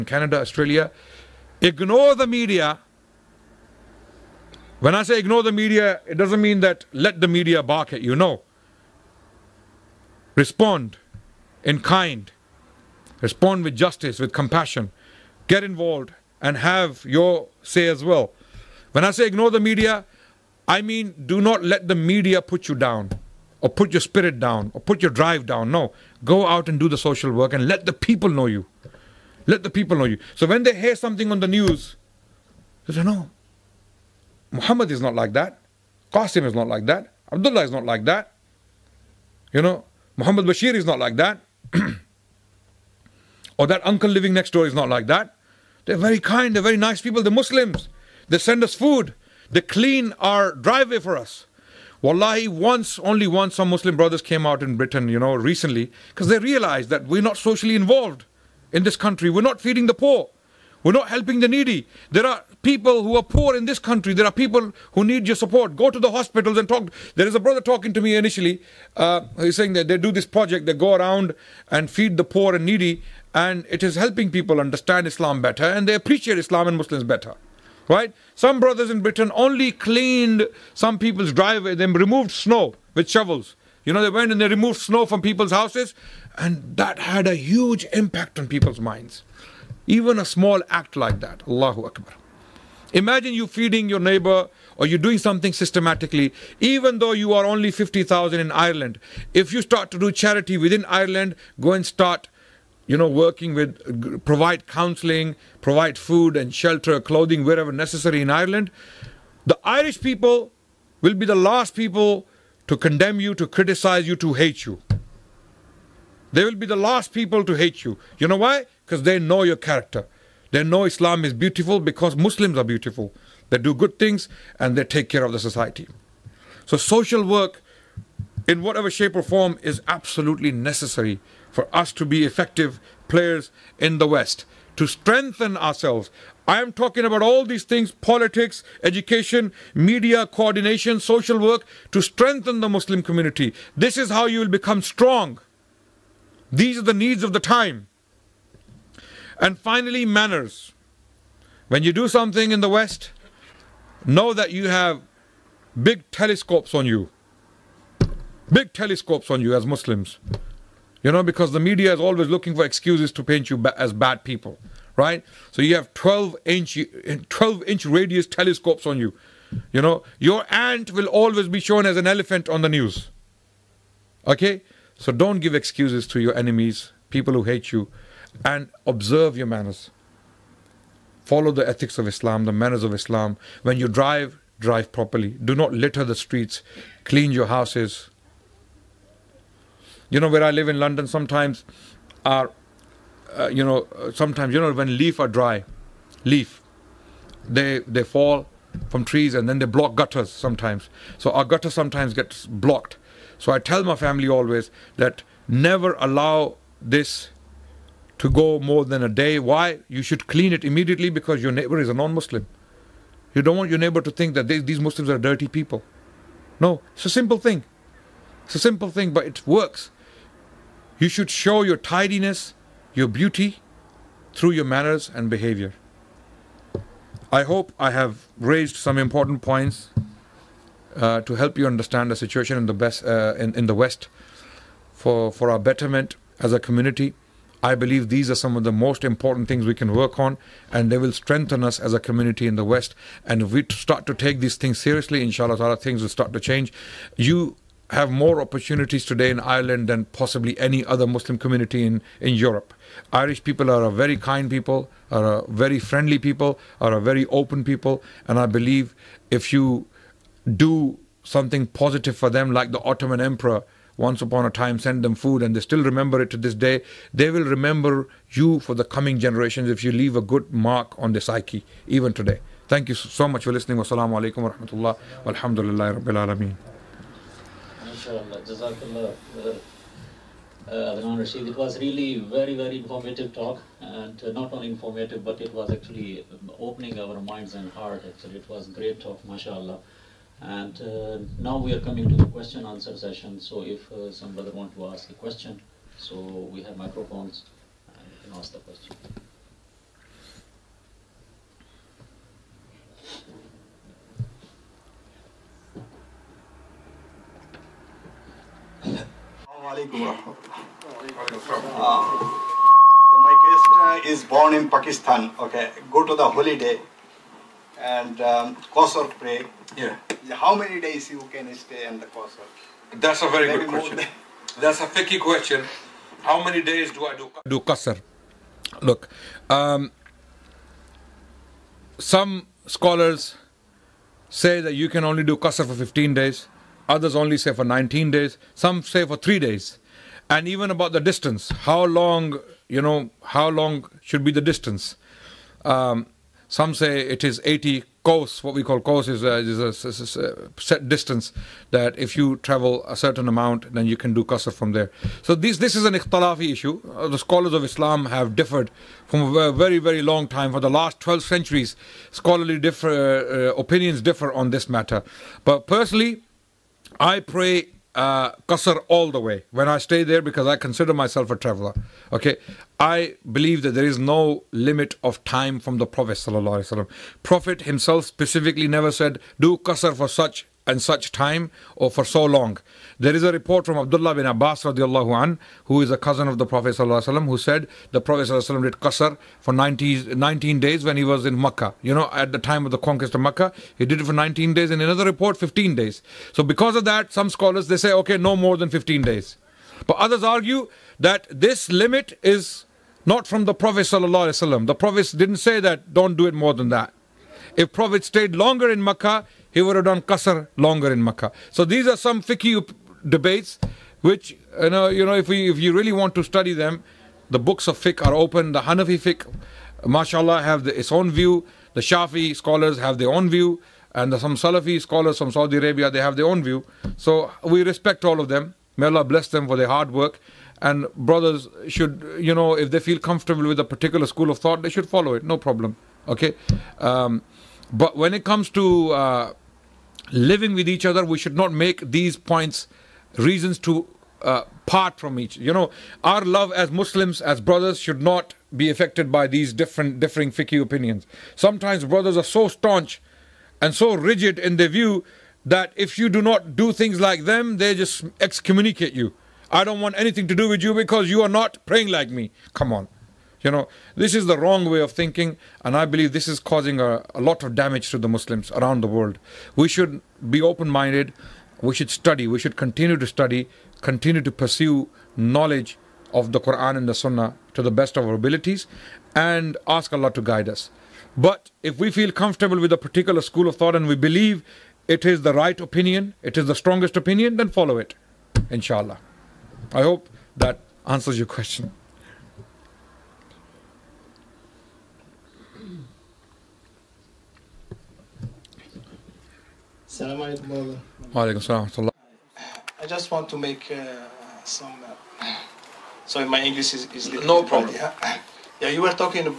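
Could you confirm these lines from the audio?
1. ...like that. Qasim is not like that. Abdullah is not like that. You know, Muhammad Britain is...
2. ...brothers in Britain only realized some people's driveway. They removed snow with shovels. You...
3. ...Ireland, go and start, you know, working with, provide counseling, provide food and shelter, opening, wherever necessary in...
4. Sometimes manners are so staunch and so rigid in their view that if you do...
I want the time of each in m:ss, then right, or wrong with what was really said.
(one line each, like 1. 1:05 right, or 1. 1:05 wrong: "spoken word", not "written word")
1. 0:35 wrong: "Bashir", not "Britain"
2. 1:18 wrong: "cleaned", not "realized"
3. 1:40 wrong: "clothing", not "opening"
4. 7:31 wrong: "brothers", not "manners".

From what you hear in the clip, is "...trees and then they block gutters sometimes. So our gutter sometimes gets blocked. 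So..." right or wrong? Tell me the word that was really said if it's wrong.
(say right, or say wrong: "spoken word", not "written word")
right.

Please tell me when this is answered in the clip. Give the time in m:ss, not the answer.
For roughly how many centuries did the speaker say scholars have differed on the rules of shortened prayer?
6:00.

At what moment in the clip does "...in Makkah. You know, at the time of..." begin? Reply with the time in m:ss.
6:31.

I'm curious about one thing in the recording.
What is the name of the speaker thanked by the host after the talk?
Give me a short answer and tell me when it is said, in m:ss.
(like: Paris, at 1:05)
Adnan Rashid, at 4:40.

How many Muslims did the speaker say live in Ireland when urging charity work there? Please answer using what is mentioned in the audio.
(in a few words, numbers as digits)
50,000.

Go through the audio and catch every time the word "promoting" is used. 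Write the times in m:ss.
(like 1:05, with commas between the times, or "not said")
not said.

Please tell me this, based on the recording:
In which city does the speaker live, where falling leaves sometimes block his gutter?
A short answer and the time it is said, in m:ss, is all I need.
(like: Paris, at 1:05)
London, at 3:10.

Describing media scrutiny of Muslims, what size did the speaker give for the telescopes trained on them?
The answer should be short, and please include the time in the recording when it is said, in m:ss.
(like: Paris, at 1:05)
12 inch, at 2:47.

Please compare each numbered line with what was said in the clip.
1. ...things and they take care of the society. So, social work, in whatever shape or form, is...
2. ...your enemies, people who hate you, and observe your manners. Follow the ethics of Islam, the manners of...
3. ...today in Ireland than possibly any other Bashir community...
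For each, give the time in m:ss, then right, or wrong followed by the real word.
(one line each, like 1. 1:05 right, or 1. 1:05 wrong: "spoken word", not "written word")
1. 2:03 right
2. 2:56 right
3. 4:09 wrong: "Muslim", not "Bashir".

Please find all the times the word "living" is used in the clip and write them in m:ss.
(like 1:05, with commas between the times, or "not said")
0:44, 7:20.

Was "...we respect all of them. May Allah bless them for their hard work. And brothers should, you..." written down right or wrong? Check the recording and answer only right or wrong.
right.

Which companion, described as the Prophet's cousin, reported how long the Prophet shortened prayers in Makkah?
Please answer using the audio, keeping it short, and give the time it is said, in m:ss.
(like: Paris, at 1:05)
Abdullah bin Abbas, at 6:23.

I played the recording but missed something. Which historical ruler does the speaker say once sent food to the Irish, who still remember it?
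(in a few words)
The Ottoman Emperor.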